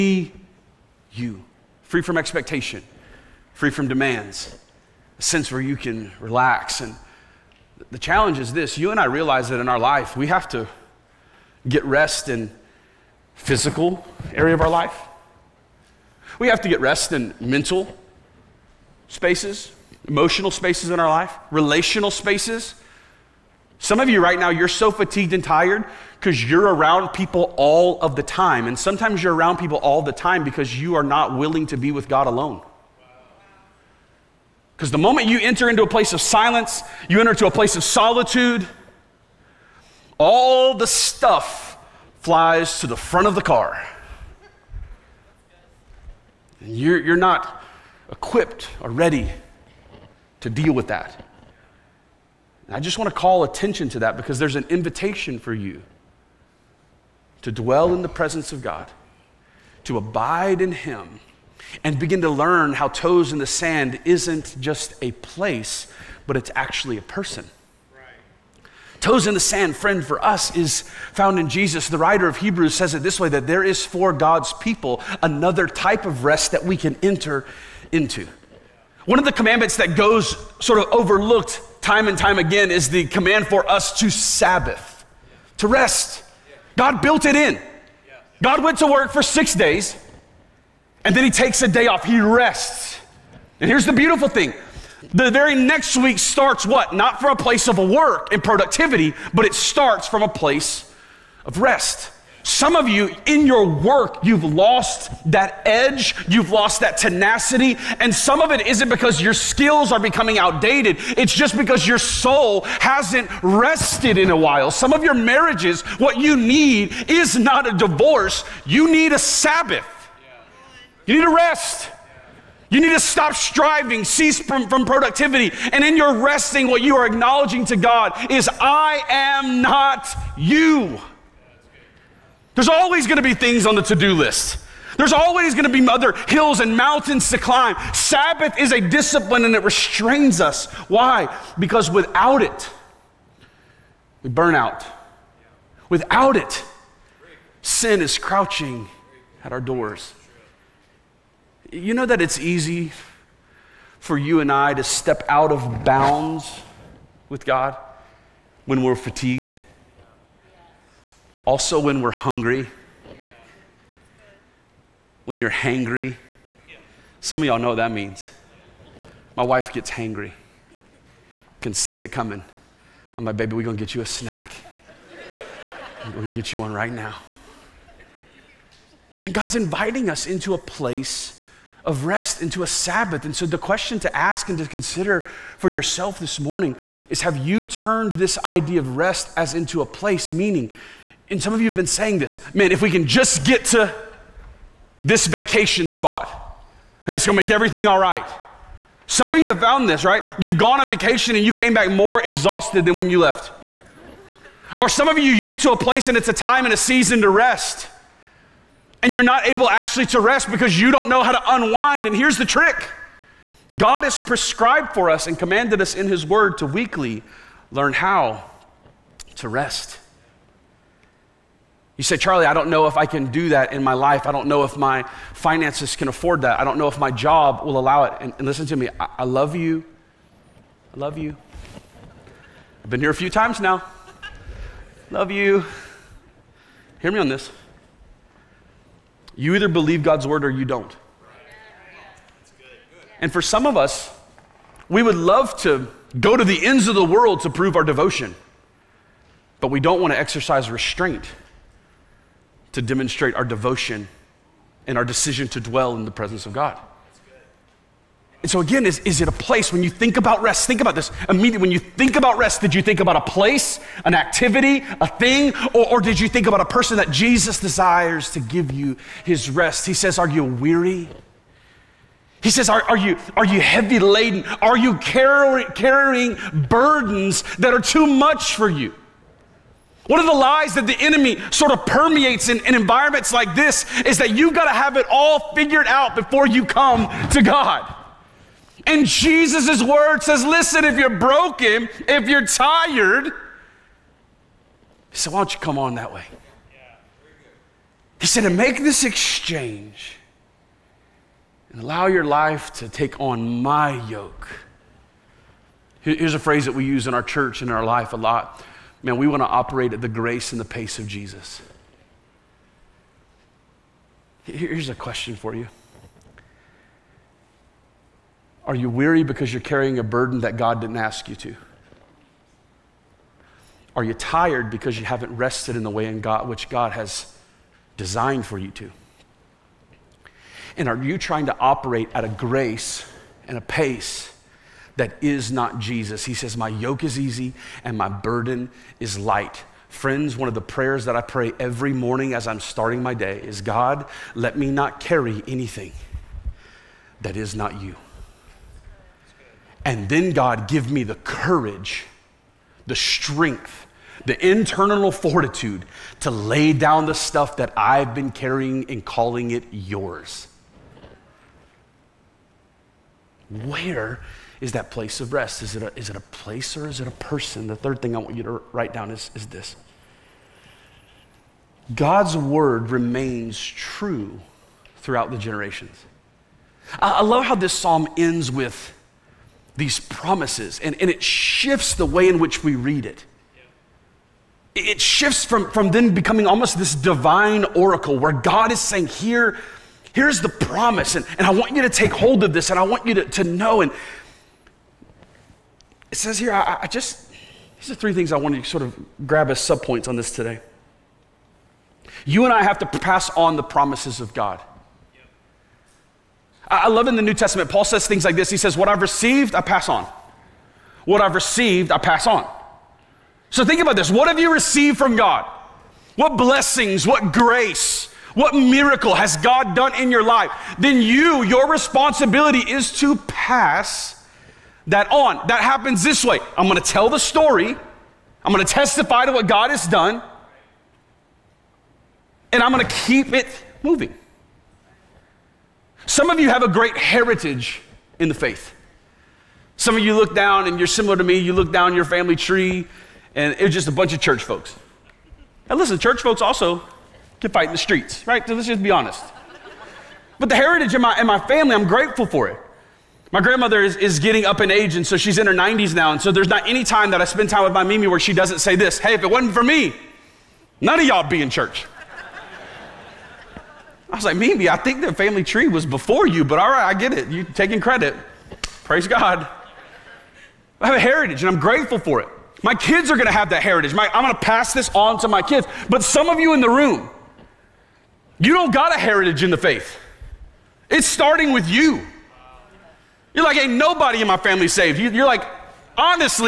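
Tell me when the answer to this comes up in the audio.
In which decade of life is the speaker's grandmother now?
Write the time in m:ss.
7:35.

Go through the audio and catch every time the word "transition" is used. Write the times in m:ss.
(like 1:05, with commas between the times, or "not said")
not said.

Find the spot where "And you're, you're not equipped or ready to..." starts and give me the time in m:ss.
0:46.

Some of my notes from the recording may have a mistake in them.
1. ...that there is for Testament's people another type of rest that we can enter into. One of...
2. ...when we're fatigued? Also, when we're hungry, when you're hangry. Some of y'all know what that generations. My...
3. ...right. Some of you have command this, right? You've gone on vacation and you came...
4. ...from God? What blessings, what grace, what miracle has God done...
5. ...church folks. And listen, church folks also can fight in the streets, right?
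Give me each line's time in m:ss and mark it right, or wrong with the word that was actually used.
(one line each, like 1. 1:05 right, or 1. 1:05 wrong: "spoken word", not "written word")
1. 1:13 wrong: "God", not "Testament"
2. 2:38 wrong: "means", not "generations"
3. 3:17 wrong: "found", not "command"
4. 6:54 right
5. 7:24 right.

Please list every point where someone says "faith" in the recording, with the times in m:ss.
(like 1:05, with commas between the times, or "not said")
7:18, 7:59.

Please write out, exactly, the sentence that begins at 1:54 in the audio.
Some of your marriages, what you need is not a divorce, you need a Sabbath.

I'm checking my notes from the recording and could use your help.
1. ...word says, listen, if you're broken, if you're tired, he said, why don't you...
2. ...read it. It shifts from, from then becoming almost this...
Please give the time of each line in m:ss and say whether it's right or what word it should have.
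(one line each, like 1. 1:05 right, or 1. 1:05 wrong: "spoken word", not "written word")
1. 4:49 right
2. 6:22 right.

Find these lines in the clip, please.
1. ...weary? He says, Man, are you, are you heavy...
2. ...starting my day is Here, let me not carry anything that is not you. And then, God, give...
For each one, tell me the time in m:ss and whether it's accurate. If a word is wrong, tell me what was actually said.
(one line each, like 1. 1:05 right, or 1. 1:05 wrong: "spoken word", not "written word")
1. 4:30 wrong: "Are", not "Man"
2. 5:42 wrong: "God", not "Here".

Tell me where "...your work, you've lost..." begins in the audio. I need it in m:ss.
1:43.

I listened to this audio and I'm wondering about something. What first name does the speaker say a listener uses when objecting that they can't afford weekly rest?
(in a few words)
Charlie.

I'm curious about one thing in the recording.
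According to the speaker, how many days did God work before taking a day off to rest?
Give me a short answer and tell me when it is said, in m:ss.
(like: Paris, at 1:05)
6, at 1:29.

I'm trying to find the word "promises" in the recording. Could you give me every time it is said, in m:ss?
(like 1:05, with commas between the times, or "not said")
6:19, 6:30, 6:43.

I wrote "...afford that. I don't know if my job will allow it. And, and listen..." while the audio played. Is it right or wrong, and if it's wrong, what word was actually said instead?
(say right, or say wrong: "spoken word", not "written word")
right.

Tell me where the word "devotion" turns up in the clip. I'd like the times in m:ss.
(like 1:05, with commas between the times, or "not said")
4:07, 4:13.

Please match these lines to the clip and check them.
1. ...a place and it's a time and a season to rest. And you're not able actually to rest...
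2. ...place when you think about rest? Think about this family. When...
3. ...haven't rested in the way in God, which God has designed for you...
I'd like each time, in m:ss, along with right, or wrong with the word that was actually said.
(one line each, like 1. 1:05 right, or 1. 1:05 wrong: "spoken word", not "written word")
1. 3:25 right
2. 4:19 wrong: "immediately", not "family"
3. 5:25 right.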